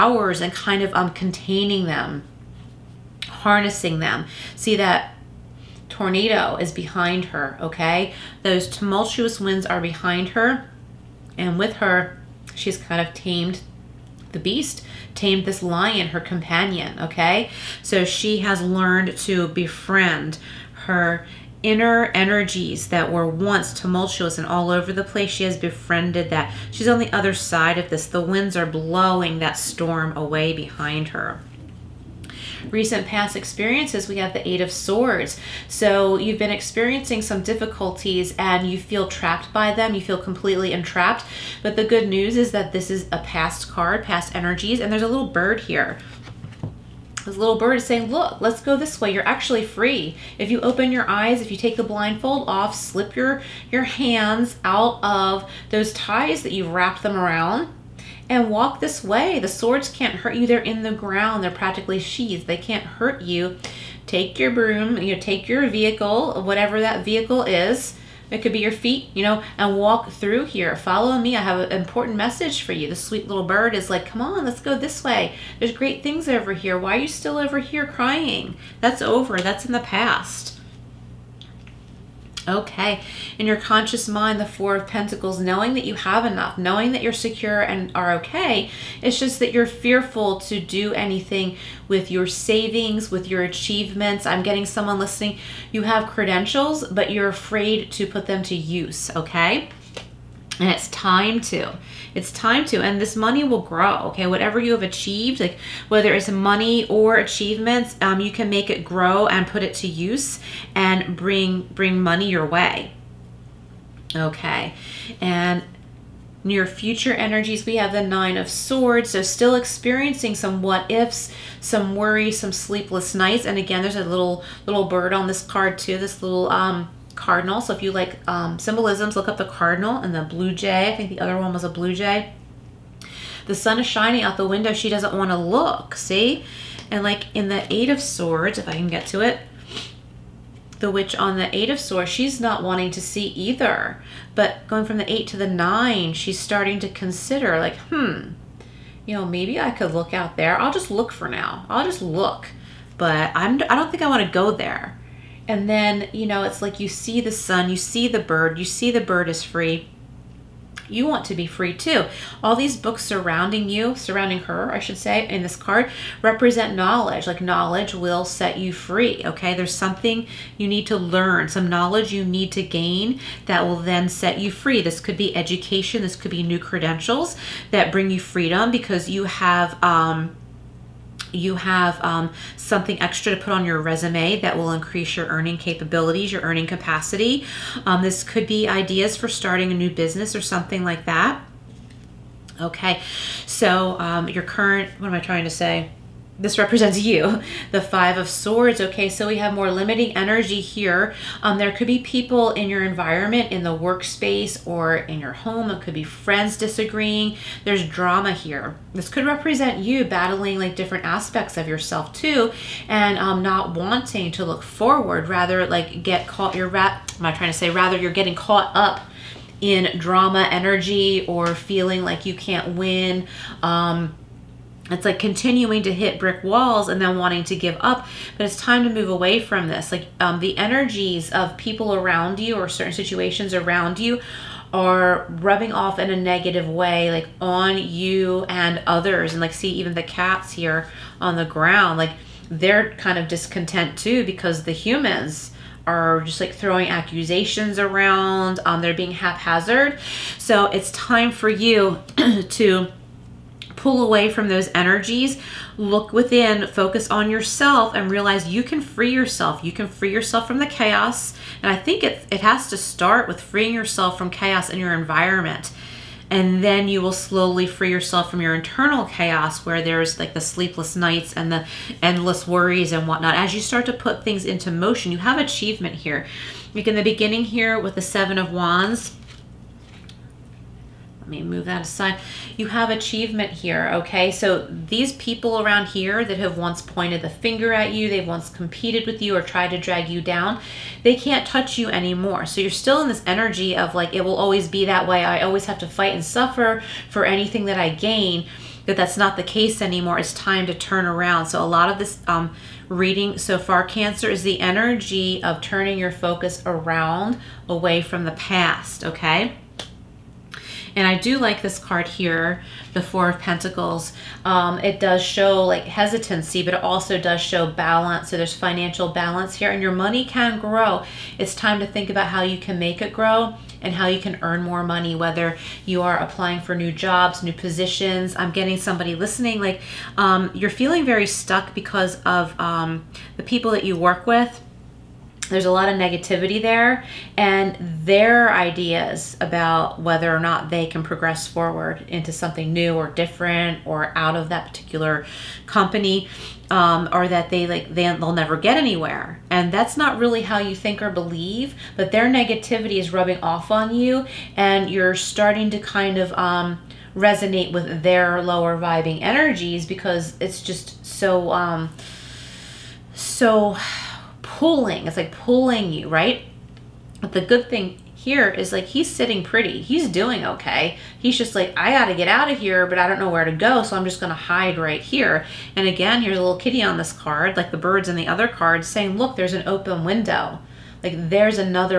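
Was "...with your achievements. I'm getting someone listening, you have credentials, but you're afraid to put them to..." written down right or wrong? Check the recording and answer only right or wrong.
right.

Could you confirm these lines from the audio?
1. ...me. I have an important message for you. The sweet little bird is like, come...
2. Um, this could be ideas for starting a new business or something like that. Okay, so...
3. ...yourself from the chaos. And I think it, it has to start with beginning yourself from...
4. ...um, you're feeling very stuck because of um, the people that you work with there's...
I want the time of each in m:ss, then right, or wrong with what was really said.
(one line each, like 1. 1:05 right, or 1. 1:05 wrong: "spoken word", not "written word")
1. 1:11 right
2. 3:07 right
3. 4:20 wrong: "freeing", not "beginning"
4. 5:30 right.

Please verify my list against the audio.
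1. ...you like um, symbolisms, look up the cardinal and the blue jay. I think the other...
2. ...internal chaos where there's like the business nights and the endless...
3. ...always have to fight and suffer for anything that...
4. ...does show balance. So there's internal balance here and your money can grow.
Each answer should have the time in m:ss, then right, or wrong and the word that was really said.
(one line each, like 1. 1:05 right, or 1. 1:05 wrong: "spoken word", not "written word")
1. 2:07 right
2. 4:28 wrong: "sleepless", not "business"
3. 4:55 right
4. 5:17 wrong: "financial", not "internal".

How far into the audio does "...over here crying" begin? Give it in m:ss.
1:17.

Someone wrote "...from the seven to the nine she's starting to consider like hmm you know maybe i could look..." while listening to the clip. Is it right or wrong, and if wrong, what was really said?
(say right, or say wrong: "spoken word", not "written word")
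wrong: "eight", not "seven".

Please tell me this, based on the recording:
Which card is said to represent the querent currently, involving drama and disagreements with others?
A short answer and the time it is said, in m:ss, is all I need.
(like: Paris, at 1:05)
Five of Swords, at 3:17.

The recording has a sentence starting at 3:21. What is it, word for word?
Um, there could be people in your environment, in the workspace, or in your home.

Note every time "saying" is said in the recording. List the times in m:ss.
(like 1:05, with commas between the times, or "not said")
0:47, 6:18.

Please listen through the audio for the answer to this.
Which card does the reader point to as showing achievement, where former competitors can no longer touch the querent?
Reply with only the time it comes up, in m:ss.
4:38.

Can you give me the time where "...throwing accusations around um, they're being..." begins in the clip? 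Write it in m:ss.
4:06.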